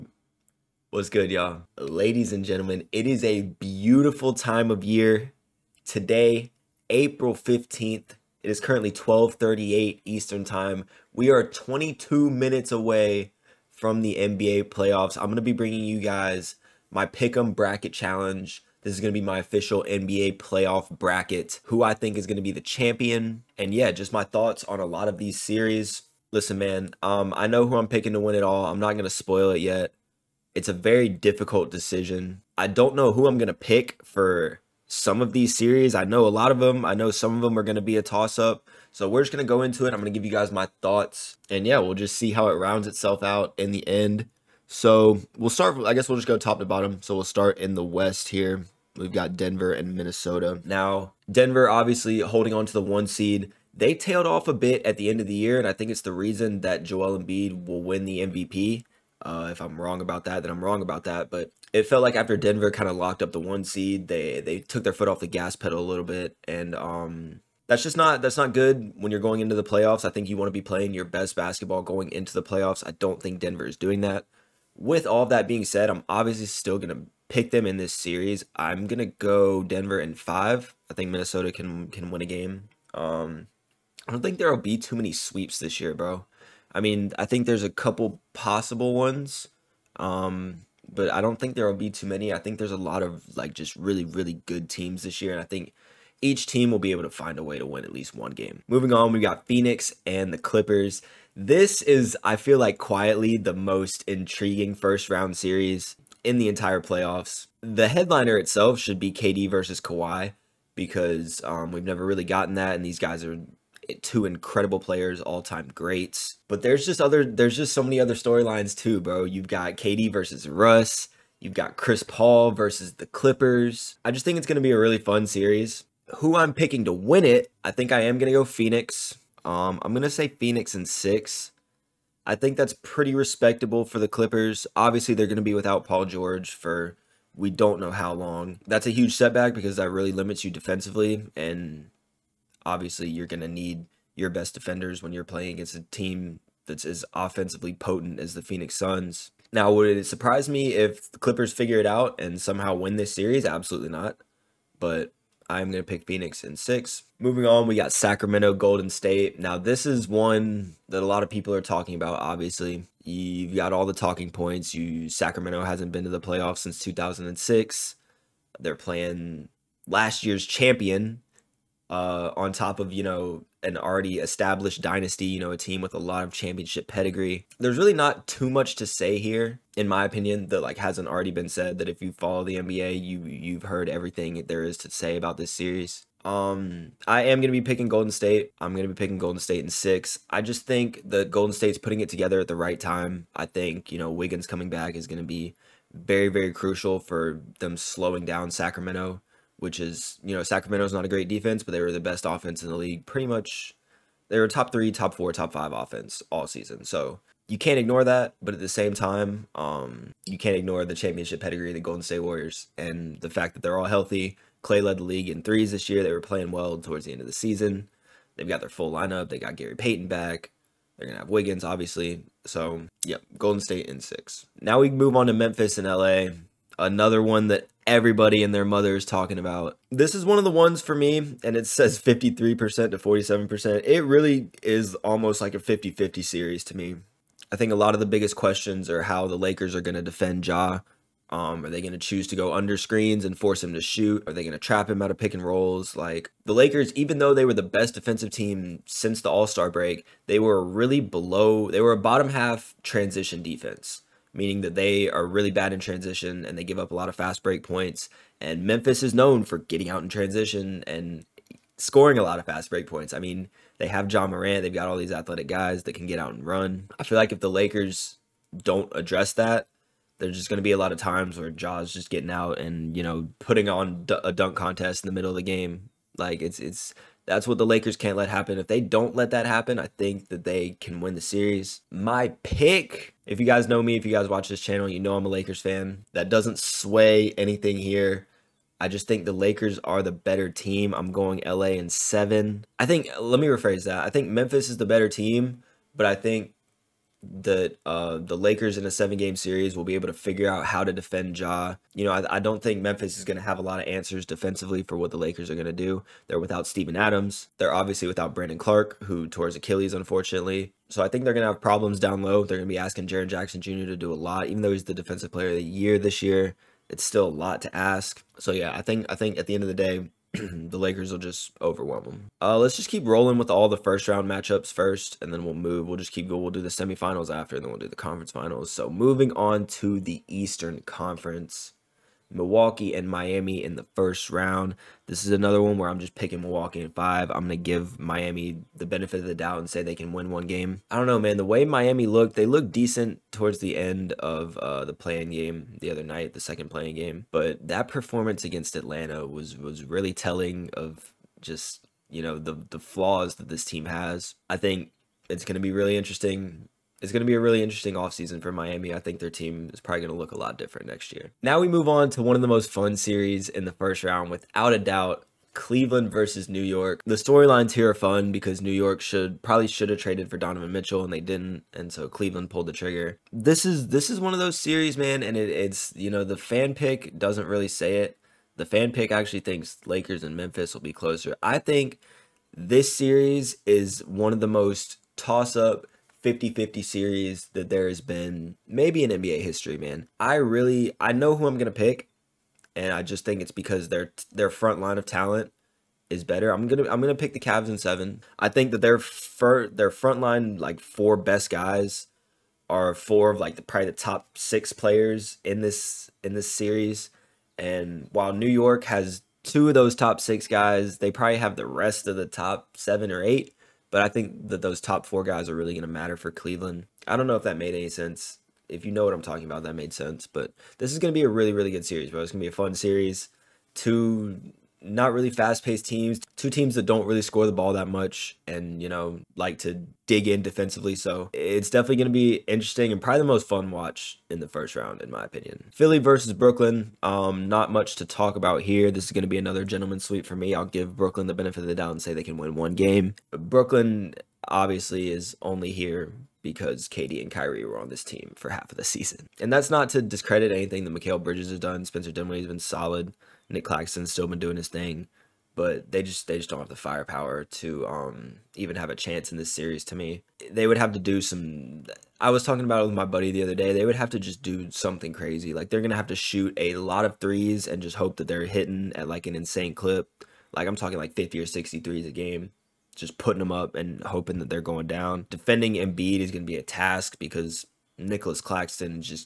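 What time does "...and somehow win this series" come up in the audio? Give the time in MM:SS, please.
02:32.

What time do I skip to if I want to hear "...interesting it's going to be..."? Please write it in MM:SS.
05:55.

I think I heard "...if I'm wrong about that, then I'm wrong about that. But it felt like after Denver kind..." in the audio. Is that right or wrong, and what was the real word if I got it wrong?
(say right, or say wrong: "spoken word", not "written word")
right.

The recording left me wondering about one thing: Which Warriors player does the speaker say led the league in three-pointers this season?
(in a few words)
Clay.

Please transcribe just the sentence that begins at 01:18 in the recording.
I'm gonna go Denver in five.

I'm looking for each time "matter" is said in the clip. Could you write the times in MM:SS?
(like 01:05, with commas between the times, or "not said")
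06:55.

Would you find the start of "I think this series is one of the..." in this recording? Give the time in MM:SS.
06:21.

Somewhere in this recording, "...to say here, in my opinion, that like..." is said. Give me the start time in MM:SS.
02:58.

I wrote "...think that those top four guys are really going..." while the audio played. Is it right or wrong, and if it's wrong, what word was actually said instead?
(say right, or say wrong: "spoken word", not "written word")
right.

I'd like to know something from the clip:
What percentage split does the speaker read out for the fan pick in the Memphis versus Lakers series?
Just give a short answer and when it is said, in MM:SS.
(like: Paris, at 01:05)
53% to 47%, at 03:51.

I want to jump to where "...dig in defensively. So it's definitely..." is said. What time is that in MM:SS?
07:10.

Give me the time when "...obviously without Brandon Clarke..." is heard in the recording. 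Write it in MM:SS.
05:07.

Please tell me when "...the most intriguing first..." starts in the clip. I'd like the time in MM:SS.
01:43.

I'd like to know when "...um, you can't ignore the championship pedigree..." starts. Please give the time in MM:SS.
03:29.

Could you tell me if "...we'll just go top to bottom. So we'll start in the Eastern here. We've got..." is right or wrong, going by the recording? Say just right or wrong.
wrong.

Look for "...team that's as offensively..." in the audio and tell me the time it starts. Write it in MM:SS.
02:25.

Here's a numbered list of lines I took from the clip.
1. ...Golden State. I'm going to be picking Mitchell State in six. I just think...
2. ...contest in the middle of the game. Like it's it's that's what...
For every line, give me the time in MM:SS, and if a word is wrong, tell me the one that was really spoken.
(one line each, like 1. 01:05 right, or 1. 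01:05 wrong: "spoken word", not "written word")
1. 03:07 wrong: "Golden", not "Mitchell"
2. 04:34 right.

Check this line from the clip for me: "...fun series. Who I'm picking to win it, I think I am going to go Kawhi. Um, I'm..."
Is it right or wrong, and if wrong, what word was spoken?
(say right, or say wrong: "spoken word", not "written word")
wrong: "Phoenix", not "Kawhi".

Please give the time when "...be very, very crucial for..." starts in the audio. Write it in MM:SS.
03:15.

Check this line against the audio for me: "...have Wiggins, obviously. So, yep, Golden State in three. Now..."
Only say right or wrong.
wrong.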